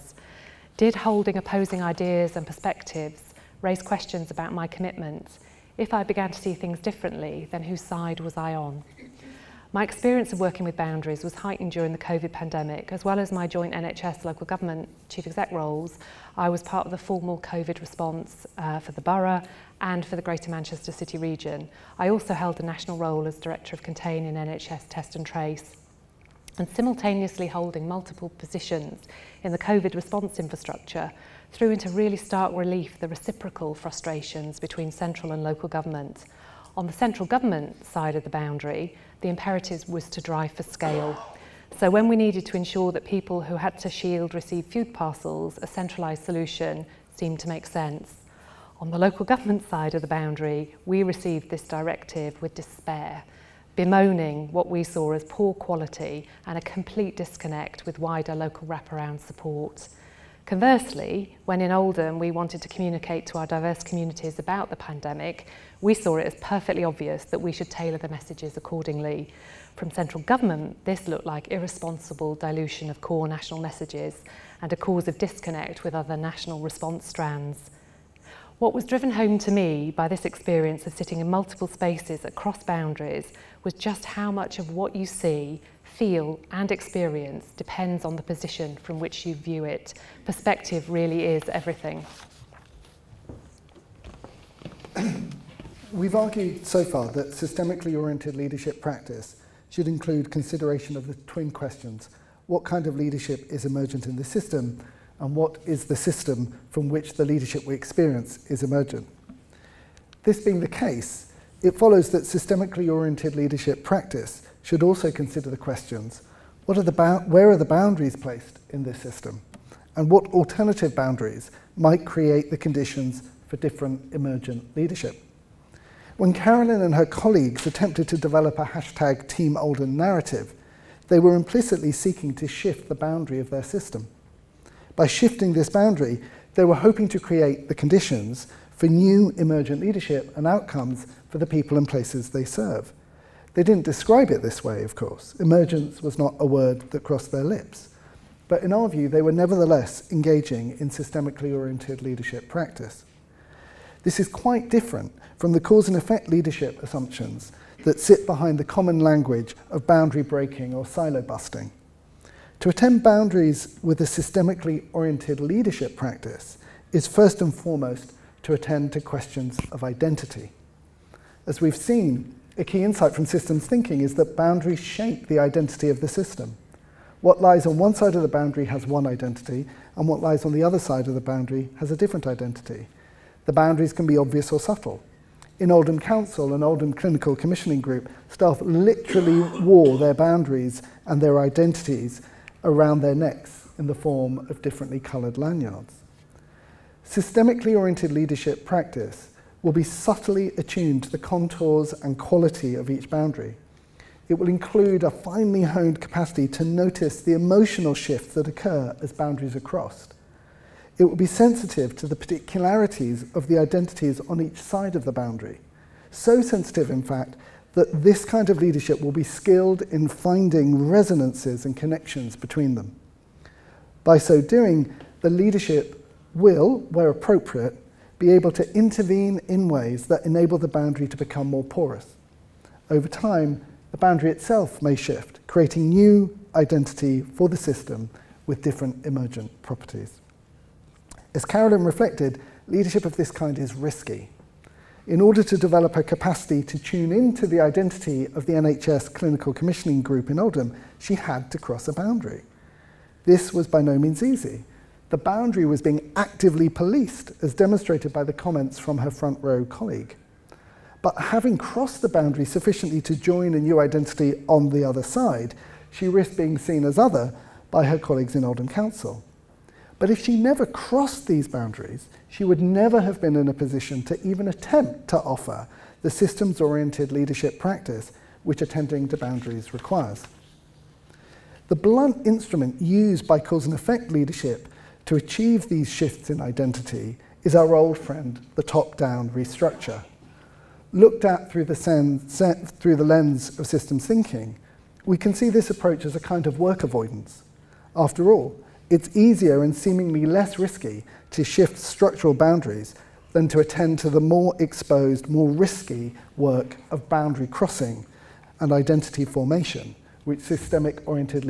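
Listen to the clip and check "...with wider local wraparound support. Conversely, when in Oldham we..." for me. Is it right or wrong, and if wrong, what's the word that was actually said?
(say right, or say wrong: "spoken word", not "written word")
right.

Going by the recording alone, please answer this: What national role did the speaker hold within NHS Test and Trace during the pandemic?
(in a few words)
Director of Contain.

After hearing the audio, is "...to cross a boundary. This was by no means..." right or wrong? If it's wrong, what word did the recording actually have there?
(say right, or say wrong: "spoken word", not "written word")
right.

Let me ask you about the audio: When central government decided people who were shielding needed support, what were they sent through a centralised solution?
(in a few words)
Food parcels.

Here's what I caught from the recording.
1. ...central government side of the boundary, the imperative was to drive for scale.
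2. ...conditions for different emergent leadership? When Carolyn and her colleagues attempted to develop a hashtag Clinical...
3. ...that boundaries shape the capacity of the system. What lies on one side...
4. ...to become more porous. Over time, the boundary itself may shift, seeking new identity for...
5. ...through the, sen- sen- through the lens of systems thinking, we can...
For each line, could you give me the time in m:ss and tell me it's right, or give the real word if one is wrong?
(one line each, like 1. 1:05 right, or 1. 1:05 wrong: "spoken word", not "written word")
1. 0:36 right
2. 2:02 wrong: "Team", not "Clinical"
3. 2:54 wrong: "identity", not "capacity"
4. 3:51 wrong: "creating", not "seeking"
5. 4:51 right.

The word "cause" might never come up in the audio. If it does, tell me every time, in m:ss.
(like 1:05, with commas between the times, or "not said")
1:14, 2:35, 4:43.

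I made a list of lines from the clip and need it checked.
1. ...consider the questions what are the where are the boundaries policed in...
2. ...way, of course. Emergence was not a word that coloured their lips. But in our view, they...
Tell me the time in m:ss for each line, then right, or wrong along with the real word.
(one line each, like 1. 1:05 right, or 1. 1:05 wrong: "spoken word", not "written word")
1. 1:55 wrong: "placed", not "policed"
2. 2:24 wrong: "crossed", not "coloured".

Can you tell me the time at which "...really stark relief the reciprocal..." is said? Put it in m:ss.
0:31.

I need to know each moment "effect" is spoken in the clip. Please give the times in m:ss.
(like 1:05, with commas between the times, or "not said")
2:35, 4:43.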